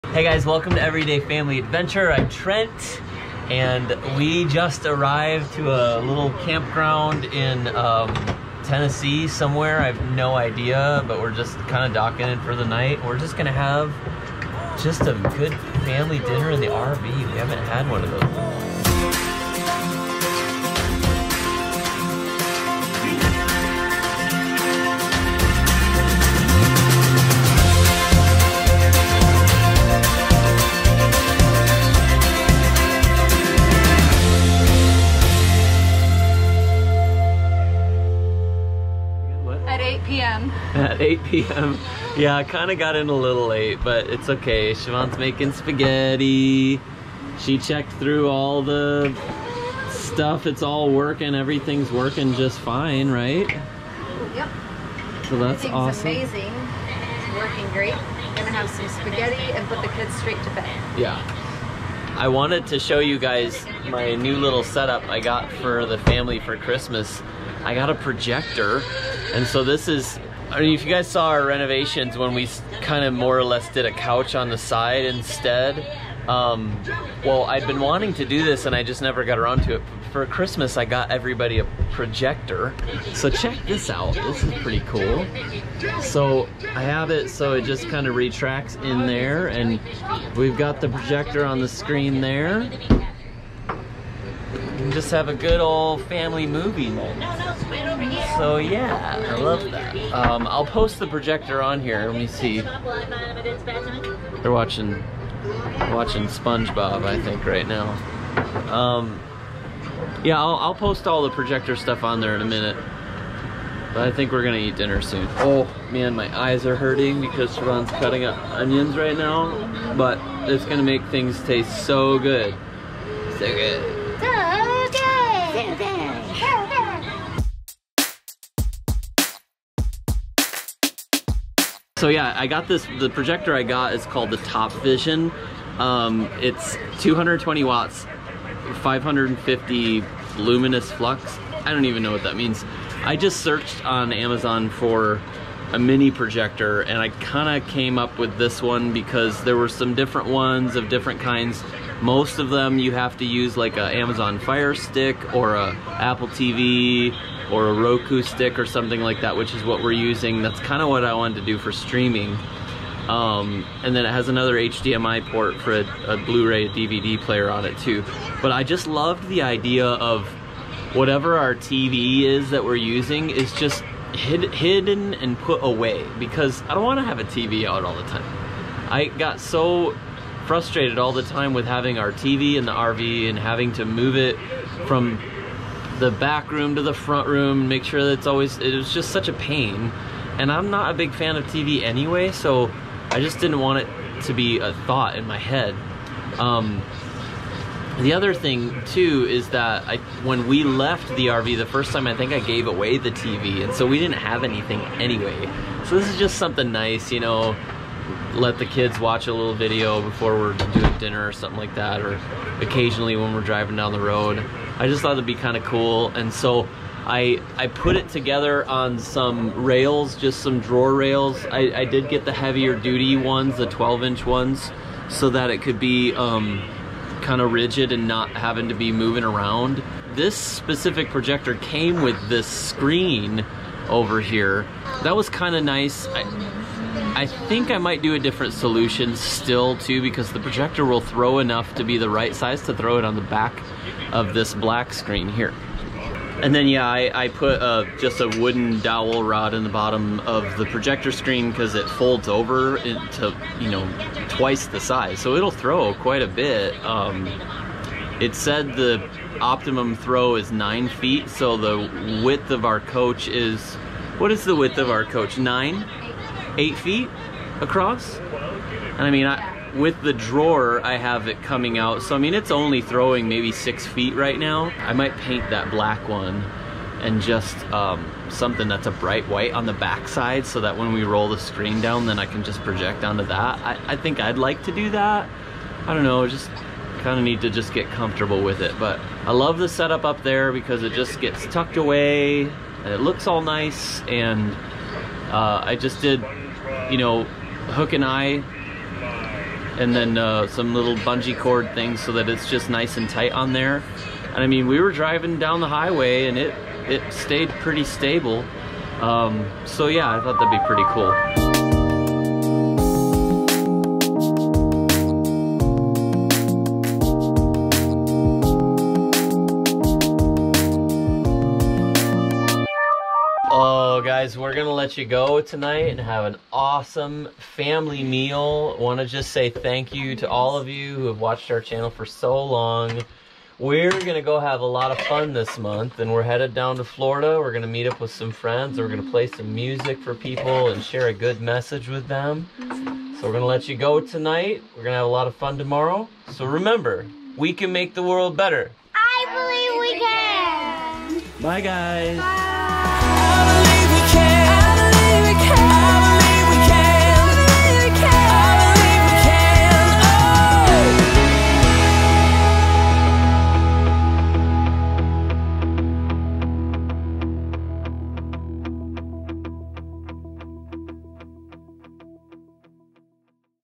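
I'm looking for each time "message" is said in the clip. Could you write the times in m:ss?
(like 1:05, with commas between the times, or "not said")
5:41.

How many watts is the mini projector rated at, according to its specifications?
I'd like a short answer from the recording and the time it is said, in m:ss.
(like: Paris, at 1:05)
220, at 2:16.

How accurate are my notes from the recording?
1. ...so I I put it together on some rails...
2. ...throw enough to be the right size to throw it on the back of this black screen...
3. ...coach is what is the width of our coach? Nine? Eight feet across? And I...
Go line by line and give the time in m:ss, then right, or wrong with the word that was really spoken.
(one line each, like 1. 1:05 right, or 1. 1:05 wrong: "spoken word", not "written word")
1. 3:36 right
2. 4:01 right
3. 4:22 right.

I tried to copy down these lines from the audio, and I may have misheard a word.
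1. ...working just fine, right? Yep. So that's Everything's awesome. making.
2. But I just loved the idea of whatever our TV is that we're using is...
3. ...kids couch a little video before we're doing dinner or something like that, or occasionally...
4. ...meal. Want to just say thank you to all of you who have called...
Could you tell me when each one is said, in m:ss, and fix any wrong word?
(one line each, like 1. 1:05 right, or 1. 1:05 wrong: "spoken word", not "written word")
1. 0:51 wrong: "amazing", not "making"
2. 2:48 right
3. 3:28 wrong: "watch", not "couch"
4. 5:28 wrong: "watched", not "called".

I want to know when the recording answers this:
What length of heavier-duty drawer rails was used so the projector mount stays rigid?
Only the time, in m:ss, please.
3:43.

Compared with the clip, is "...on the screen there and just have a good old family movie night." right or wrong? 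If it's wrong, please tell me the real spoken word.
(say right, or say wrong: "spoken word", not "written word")
right.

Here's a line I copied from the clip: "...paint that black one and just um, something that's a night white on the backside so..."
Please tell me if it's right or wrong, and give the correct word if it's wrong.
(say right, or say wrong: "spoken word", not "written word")
wrong: "bright", not "night".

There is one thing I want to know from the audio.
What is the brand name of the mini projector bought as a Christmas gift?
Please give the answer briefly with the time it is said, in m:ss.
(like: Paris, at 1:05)
Top Vision, at 2:14.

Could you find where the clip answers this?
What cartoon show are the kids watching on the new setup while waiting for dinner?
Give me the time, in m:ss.
1:46.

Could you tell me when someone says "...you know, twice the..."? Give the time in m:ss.
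4:13.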